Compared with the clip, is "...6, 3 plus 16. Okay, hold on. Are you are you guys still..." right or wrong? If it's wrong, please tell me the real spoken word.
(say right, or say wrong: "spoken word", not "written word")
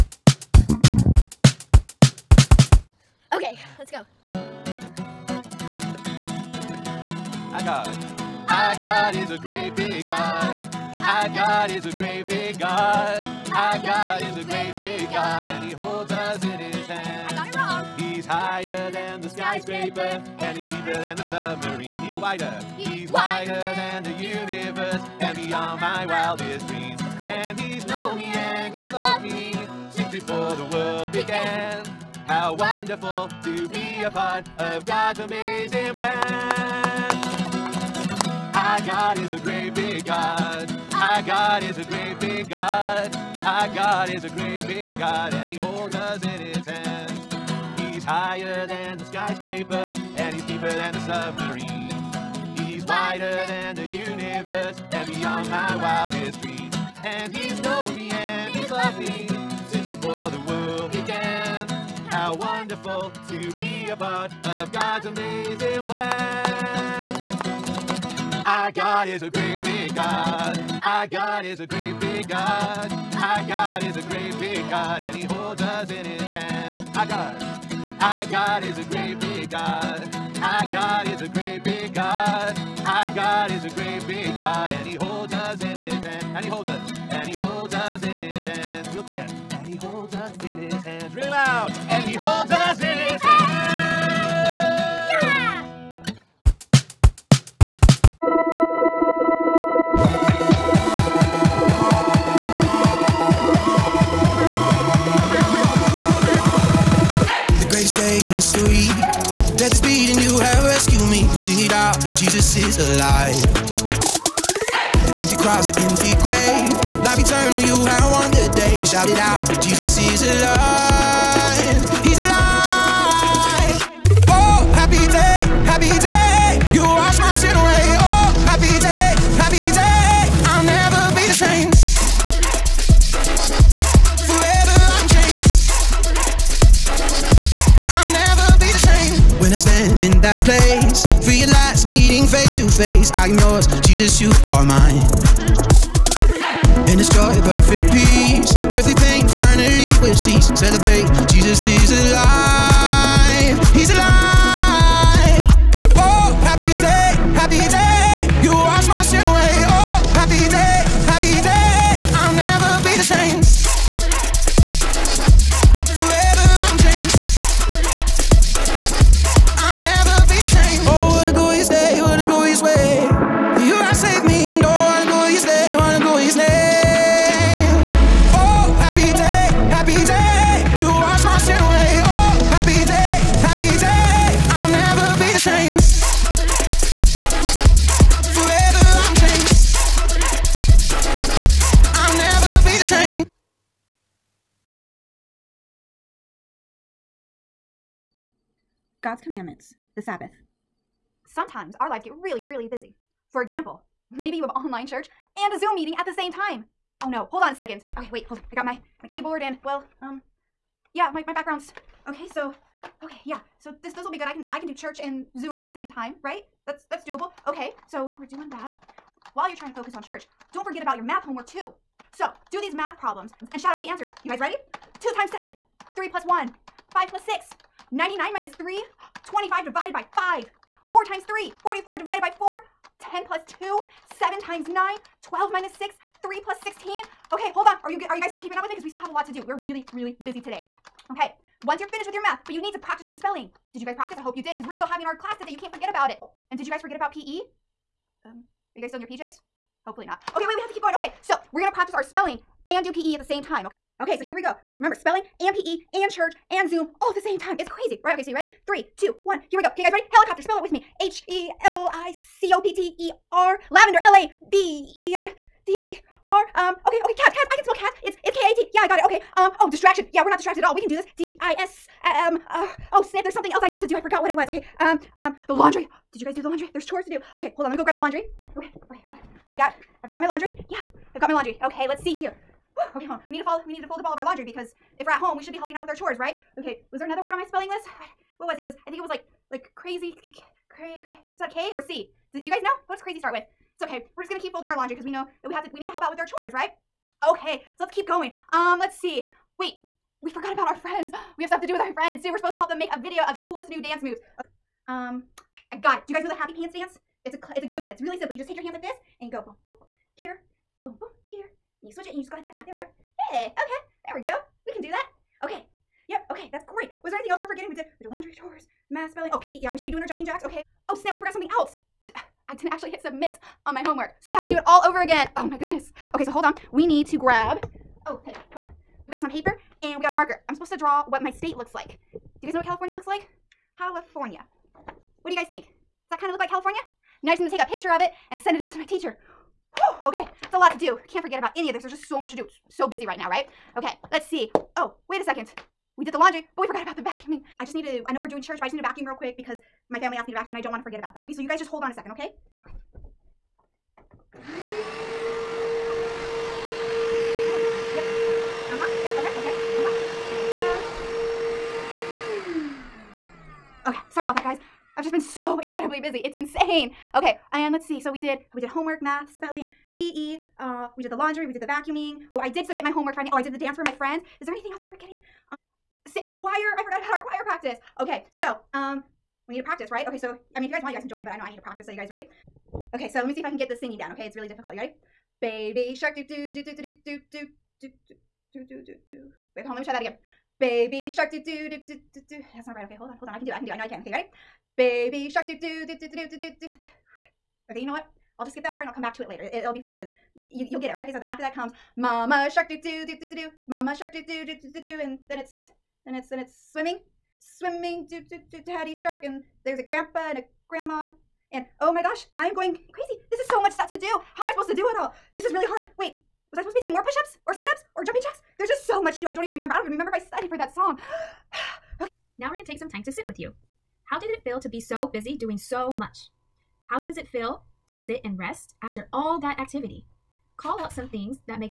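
right.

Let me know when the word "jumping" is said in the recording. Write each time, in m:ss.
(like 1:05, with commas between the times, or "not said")
5:20, 6:58.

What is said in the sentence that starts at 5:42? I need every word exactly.
It's so busy right now, right?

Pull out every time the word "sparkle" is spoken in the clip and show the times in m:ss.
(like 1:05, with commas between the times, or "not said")
not said.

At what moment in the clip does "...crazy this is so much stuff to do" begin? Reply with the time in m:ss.
6:52.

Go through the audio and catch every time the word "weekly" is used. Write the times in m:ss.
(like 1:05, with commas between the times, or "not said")
not said.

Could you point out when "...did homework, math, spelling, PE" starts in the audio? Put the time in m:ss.
6:08.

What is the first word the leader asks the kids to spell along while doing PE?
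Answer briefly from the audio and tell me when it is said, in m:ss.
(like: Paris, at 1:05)
Helicopter, at 4:20.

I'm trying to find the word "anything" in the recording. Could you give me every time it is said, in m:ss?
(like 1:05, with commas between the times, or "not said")
5:17, 6:14.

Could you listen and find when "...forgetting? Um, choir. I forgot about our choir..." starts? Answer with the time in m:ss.
6:14.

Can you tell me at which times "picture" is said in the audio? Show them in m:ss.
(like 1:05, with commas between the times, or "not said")
5:37.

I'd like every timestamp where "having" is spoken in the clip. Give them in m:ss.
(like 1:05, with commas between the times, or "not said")
4:04.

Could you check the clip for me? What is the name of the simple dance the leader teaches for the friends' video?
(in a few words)
happy pants dance.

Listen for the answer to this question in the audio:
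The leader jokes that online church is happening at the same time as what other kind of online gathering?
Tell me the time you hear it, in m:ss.
3:25.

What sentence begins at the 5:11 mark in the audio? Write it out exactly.
And you switch it and you just go like that.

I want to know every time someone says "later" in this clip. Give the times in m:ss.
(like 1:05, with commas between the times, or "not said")
6:39.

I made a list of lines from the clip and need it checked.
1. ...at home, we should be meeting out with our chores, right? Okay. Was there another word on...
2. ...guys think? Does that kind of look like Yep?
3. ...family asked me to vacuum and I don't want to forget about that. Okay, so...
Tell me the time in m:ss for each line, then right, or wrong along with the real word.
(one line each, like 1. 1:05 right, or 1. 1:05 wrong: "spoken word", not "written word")
1. 4:45 wrong: "helping", not "meeting"
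2. 5:35 wrong: "California", not "Yep"
3. 5:49 right.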